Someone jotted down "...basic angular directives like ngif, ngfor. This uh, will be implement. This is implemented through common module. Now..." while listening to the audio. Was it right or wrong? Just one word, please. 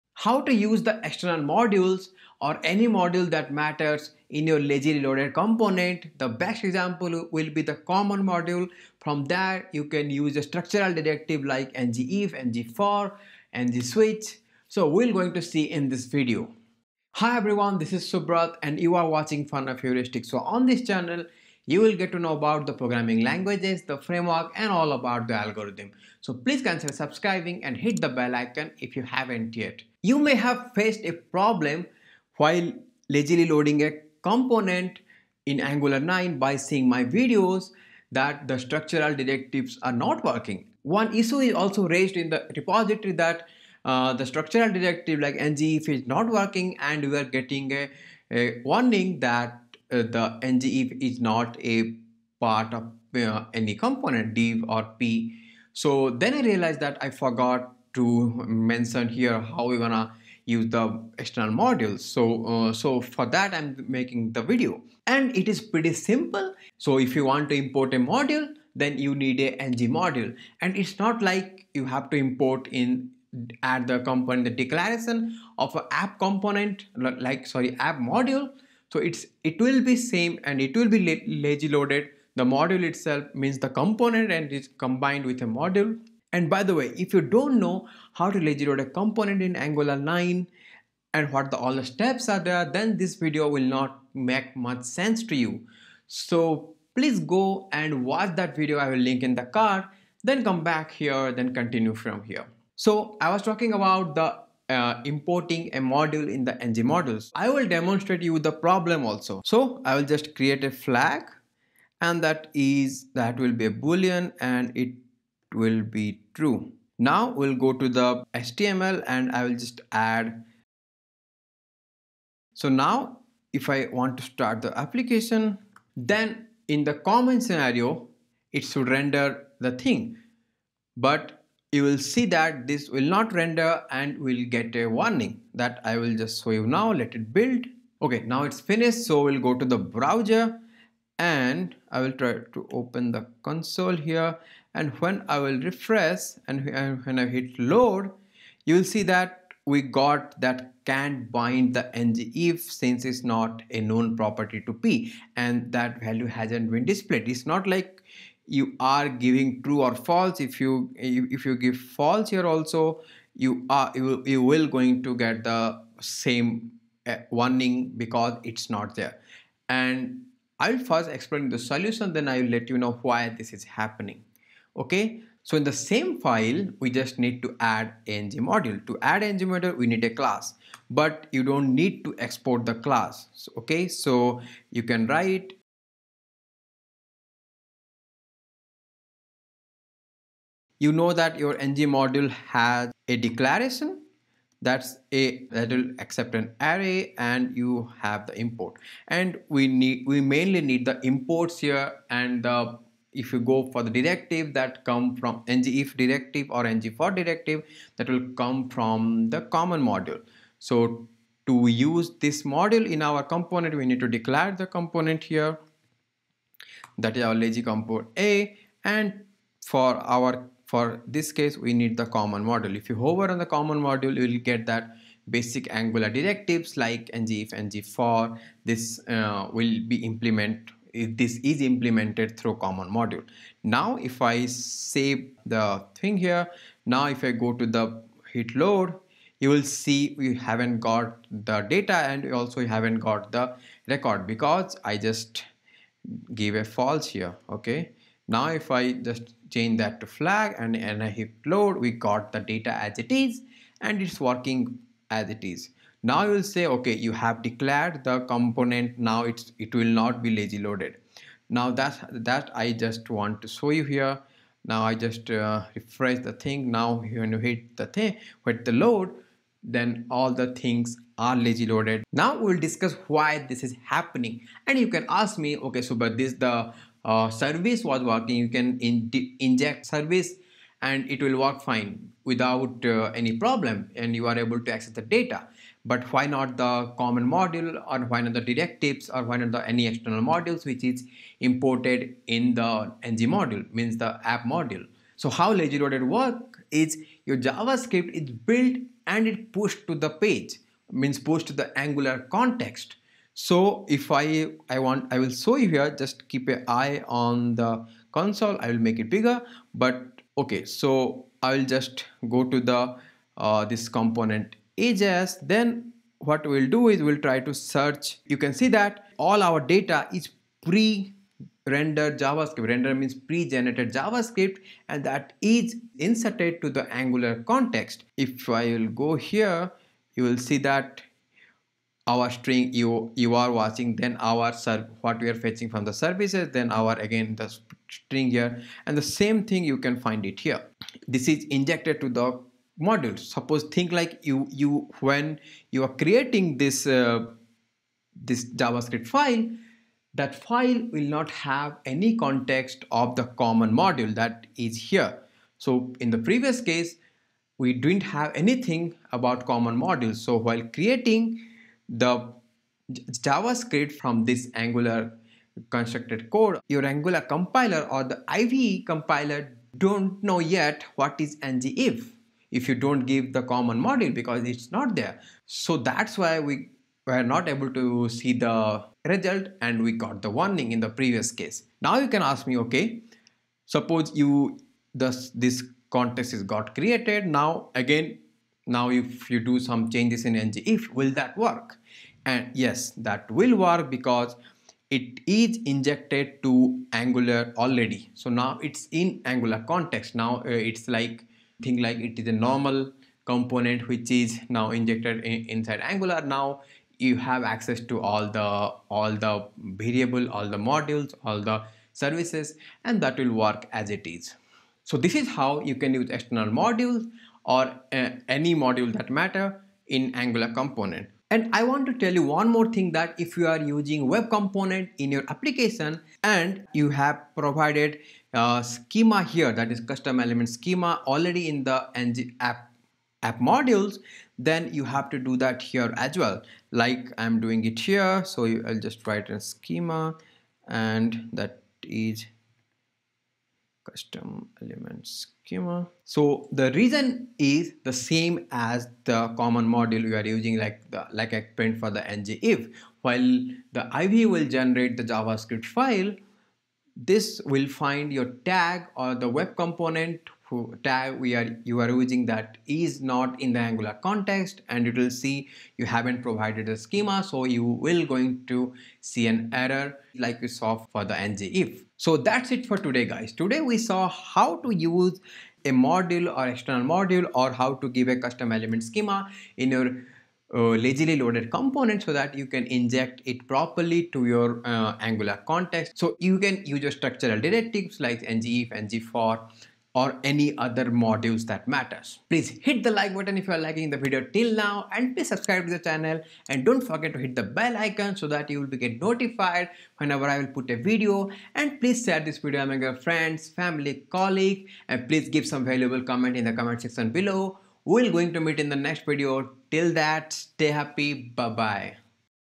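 right.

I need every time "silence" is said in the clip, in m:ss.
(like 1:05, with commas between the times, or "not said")
not said.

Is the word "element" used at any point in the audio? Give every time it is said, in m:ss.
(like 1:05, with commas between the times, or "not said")
7:10, 7:24, 7:58.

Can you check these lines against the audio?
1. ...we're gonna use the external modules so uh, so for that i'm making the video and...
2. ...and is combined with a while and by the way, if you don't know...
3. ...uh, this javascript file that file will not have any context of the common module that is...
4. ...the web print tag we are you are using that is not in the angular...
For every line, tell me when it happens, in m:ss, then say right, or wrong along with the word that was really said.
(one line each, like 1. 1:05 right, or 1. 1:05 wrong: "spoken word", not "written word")
1. 0:59 right
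2. 1:24 wrong: "module", not "while"
3. 5:46 right
4. 7:39 wrong: "component", not "print".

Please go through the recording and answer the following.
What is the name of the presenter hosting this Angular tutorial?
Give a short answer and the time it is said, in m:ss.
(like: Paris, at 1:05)
Subrat, at 0:18.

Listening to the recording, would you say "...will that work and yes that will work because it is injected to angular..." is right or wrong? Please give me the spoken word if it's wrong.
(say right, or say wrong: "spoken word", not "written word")
right.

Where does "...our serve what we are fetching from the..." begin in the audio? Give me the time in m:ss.
5:34.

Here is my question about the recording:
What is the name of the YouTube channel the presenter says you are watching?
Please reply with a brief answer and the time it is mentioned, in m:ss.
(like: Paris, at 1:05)
Fun of Heuristics, at 0:19.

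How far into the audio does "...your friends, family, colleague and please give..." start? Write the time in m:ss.
8:22.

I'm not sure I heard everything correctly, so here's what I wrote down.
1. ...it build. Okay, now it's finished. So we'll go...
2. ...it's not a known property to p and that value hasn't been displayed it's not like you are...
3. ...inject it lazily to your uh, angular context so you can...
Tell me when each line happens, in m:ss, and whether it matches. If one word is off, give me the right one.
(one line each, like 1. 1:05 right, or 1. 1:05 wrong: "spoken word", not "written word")
1. 2:17 right
2. 2:33 right
3. 8:02 wrong: "properly", not "lazily".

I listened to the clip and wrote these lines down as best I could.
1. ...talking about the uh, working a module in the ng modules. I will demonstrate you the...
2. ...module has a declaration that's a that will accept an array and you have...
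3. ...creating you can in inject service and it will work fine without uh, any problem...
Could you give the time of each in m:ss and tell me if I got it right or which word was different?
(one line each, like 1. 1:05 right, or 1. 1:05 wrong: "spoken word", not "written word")
1. 1:43 wrong: "importing", not "working"
2. 3:11 right
3. 4:38 wrong: "working", not "creating".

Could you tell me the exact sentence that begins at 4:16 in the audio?
Now you will say, okay, you have declared the component.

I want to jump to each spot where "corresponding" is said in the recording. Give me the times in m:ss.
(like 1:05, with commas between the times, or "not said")
not said.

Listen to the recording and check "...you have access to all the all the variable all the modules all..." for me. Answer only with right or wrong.
right.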